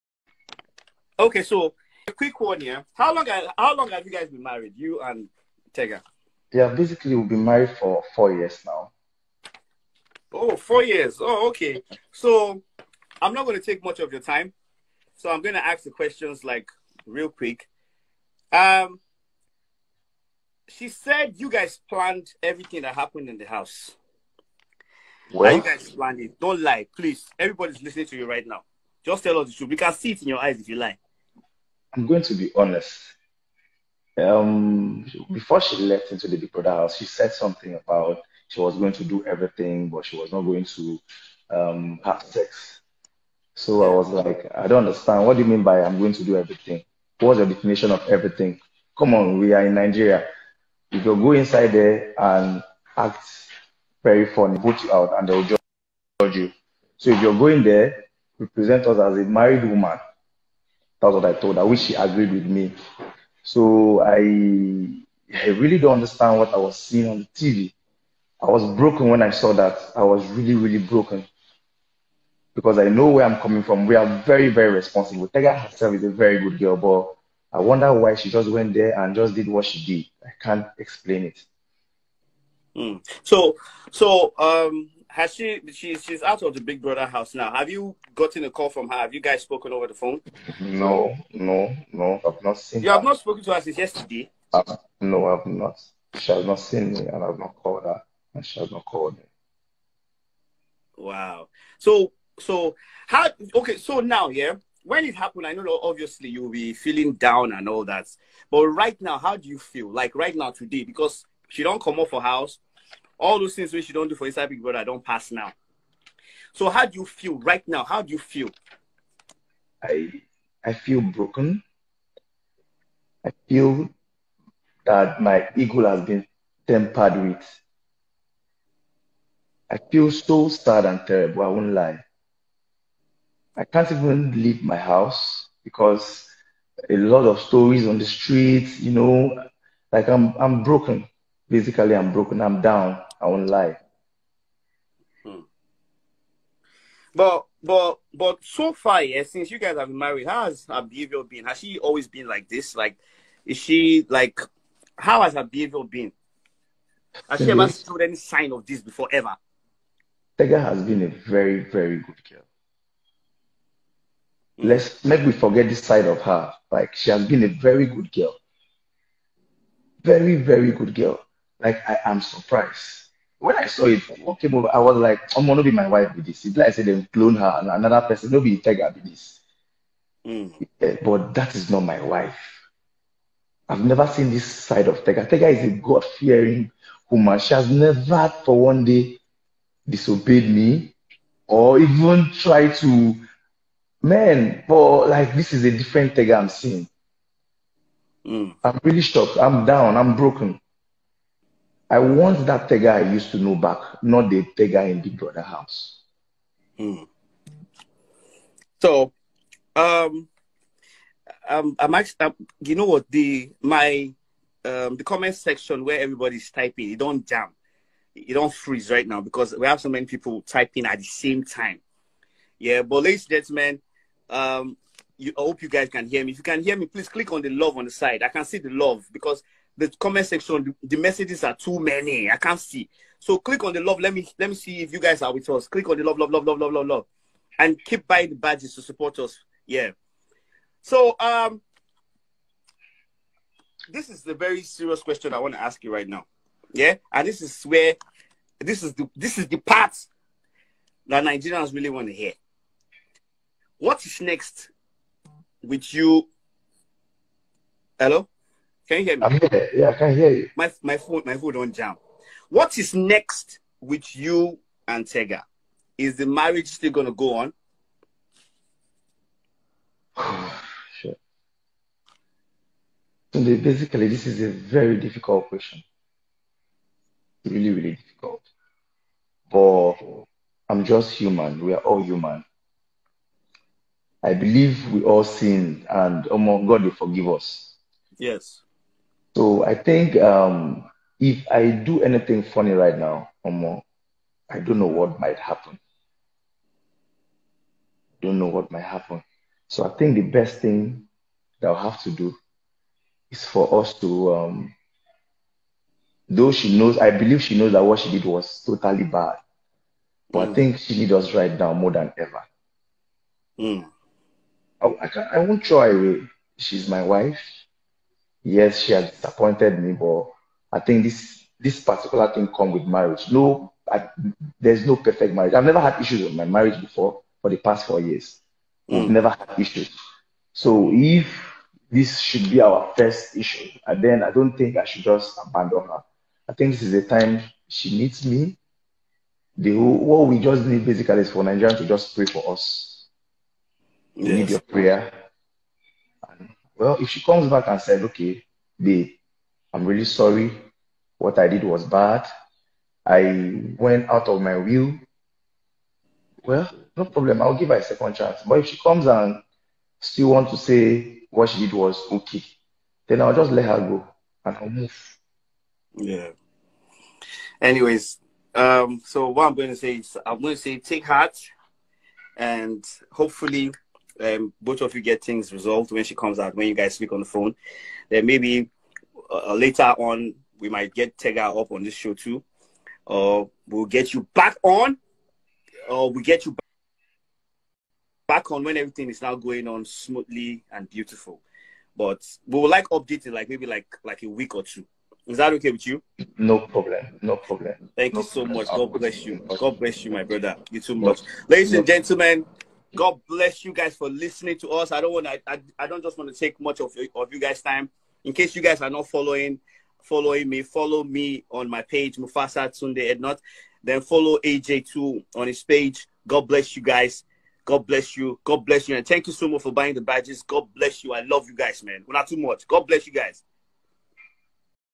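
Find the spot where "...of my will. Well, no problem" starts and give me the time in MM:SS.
05:54.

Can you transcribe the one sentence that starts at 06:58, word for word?
And thank you so much for buying the badges.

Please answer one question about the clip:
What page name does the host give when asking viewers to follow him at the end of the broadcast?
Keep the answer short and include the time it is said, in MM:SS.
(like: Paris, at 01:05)
Mufasa Tunde Ednut, at 06:52.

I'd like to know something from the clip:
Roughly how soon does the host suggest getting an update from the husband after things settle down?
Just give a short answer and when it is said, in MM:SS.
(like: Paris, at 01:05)
a week or two, at 06:34.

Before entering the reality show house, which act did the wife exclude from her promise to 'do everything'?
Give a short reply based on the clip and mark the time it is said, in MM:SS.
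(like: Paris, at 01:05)
have sex, at 00:42.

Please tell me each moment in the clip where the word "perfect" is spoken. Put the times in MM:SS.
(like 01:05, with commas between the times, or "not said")
05:24.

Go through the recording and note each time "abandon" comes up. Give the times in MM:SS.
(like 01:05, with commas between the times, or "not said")
05:35.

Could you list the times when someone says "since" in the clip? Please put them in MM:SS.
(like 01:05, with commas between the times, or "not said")
01:33, 02:29.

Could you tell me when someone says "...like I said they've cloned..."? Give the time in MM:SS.
02:56.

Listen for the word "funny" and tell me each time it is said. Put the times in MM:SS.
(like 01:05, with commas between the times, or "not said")
00:54, 04:52.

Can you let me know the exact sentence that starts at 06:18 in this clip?
Then maybe uh, later on, we might get Tega up on this show too.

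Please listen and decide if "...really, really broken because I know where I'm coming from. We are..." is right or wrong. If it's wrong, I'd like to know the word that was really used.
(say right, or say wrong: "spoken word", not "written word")
right.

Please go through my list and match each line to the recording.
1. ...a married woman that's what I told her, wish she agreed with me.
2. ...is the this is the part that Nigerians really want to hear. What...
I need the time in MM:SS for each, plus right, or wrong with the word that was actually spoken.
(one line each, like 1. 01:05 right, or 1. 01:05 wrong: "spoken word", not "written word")
1. 00:59 right
2. 04:08 right.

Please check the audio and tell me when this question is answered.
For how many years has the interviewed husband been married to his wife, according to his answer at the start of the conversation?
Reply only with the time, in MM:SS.
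00:08.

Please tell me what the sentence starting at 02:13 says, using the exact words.
I can't even leave my house because a lot of stories on the streets, you know, like I'm I'm broken.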